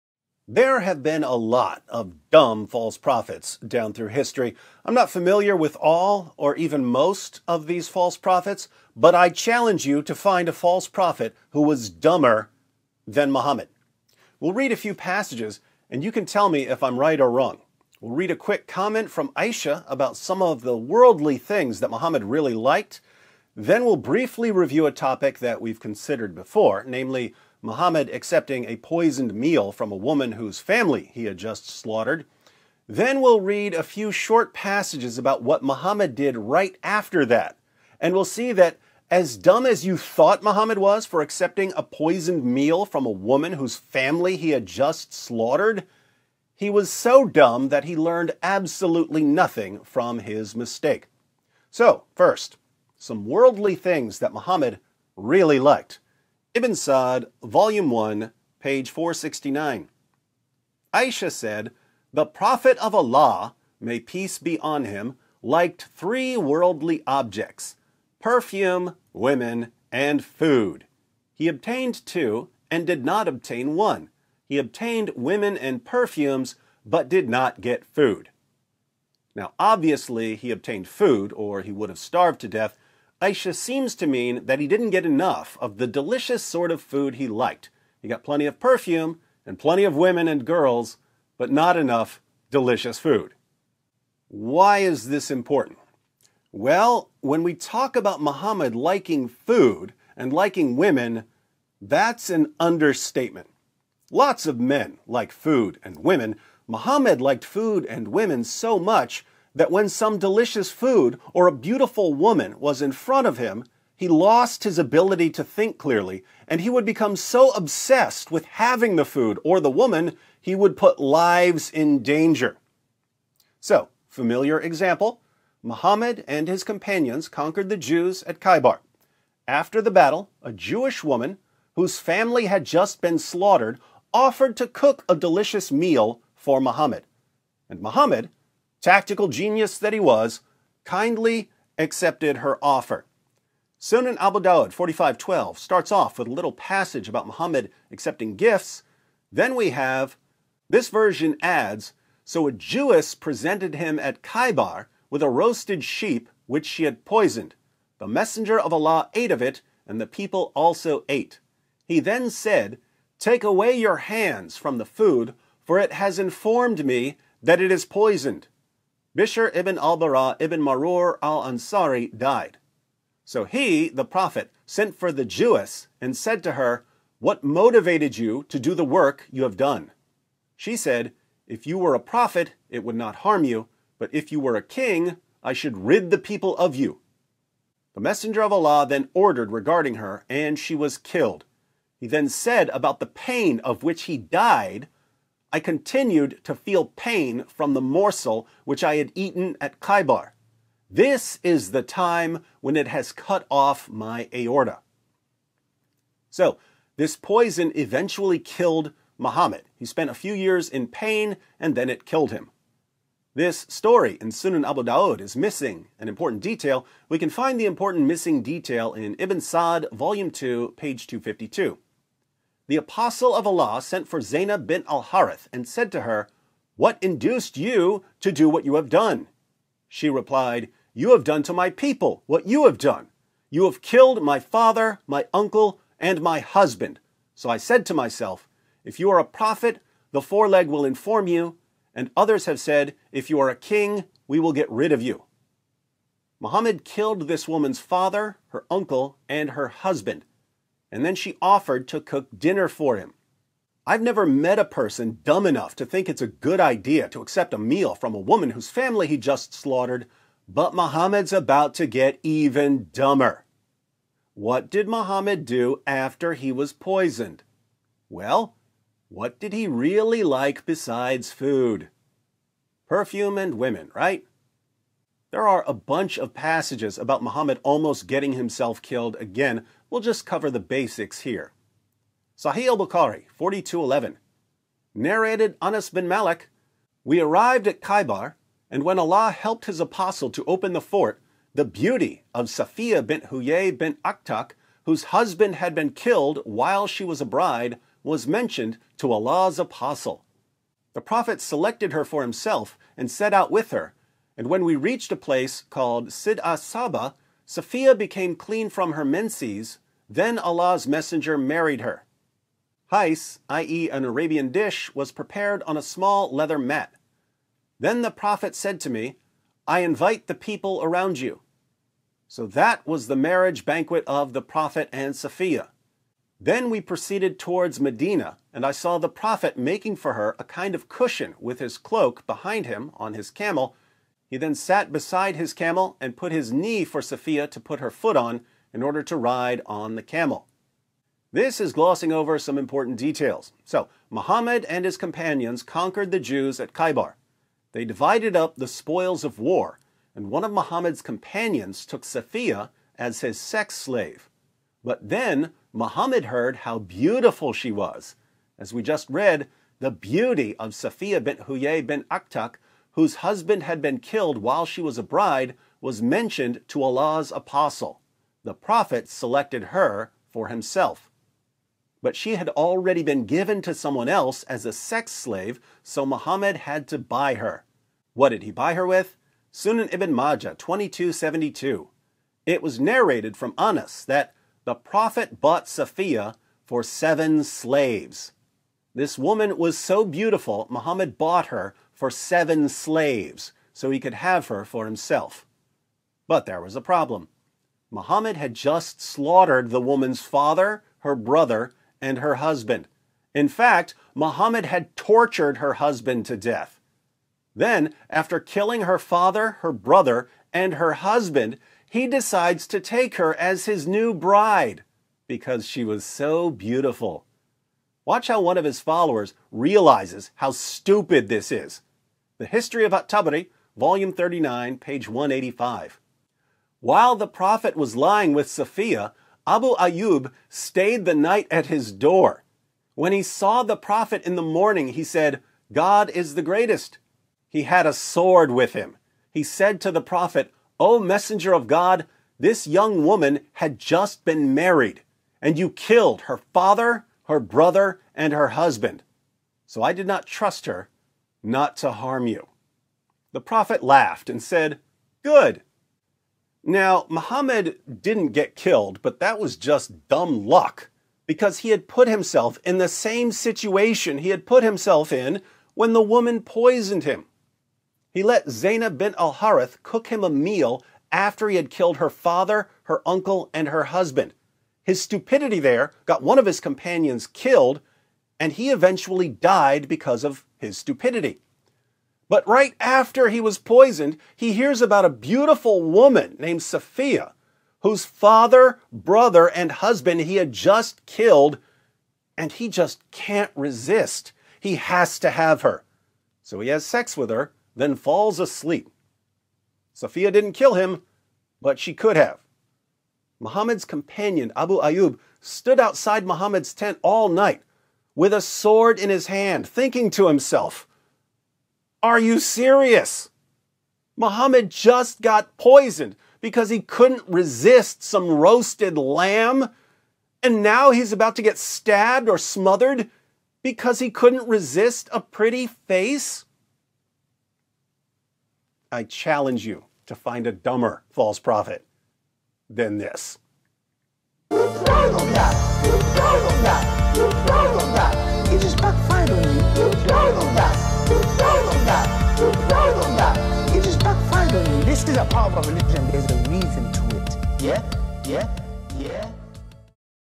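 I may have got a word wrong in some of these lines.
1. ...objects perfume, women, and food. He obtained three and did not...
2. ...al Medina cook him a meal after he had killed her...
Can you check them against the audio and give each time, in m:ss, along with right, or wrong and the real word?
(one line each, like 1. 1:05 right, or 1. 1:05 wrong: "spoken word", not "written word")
1. 1:07 wrong: "two", not "three"
2. 7:49 wrong: "Harith", not "Medina".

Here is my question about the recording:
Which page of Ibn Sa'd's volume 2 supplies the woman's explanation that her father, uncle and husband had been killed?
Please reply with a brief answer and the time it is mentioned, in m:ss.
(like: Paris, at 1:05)
252, at 3:41.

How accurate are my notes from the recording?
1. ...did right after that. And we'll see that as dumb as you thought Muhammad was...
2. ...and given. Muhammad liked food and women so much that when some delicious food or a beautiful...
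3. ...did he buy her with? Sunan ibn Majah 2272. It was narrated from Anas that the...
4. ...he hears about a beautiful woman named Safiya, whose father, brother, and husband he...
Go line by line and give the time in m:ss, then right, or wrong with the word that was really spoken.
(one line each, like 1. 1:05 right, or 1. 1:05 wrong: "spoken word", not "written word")
1. 0:36 right
2. 1:45 wrong: "women", not "given"
3. 6:18 right
4. 8:04 right.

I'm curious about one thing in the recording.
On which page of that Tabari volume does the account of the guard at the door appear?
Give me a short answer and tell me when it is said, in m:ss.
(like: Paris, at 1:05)
185, at 7:05.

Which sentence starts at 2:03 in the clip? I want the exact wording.
So, familiar example Muhammad and his companions conquered the Jews at Khaybar.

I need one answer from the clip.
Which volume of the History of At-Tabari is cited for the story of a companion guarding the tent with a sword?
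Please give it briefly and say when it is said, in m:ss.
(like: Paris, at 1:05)
39, at 7:04.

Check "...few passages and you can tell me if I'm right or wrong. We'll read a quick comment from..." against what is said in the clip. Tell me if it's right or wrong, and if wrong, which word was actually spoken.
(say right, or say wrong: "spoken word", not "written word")
right.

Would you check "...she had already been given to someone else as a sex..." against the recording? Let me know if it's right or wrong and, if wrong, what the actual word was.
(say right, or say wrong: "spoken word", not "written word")
right.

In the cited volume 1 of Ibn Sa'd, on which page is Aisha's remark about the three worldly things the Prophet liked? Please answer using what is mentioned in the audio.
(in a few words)
469.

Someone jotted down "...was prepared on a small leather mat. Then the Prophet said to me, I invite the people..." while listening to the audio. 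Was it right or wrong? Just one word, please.
right.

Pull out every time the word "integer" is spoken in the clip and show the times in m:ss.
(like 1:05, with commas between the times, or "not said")
not said.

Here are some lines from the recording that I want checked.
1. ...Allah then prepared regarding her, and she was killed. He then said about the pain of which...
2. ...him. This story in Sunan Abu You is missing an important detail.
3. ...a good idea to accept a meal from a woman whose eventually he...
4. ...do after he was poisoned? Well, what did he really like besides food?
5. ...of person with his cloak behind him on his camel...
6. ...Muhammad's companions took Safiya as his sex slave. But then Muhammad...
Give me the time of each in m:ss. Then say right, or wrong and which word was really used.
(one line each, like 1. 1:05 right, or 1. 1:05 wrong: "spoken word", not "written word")
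1. 3:08 wrong: "ordered", not "prepared"
2. 3:32 wrong: "Dawud", not "You"
3. 4:16 wrong: "family", not "eventually"
4. 4:25 right
5. 5:30 wrong: "cushion", not "person"
6. 5:50 right.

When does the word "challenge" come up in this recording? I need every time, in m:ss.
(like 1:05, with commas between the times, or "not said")
0:09, 8:49.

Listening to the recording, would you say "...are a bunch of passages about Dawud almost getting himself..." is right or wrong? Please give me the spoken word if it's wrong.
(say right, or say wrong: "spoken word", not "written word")
wrong: "Muhammad", not "Dawud".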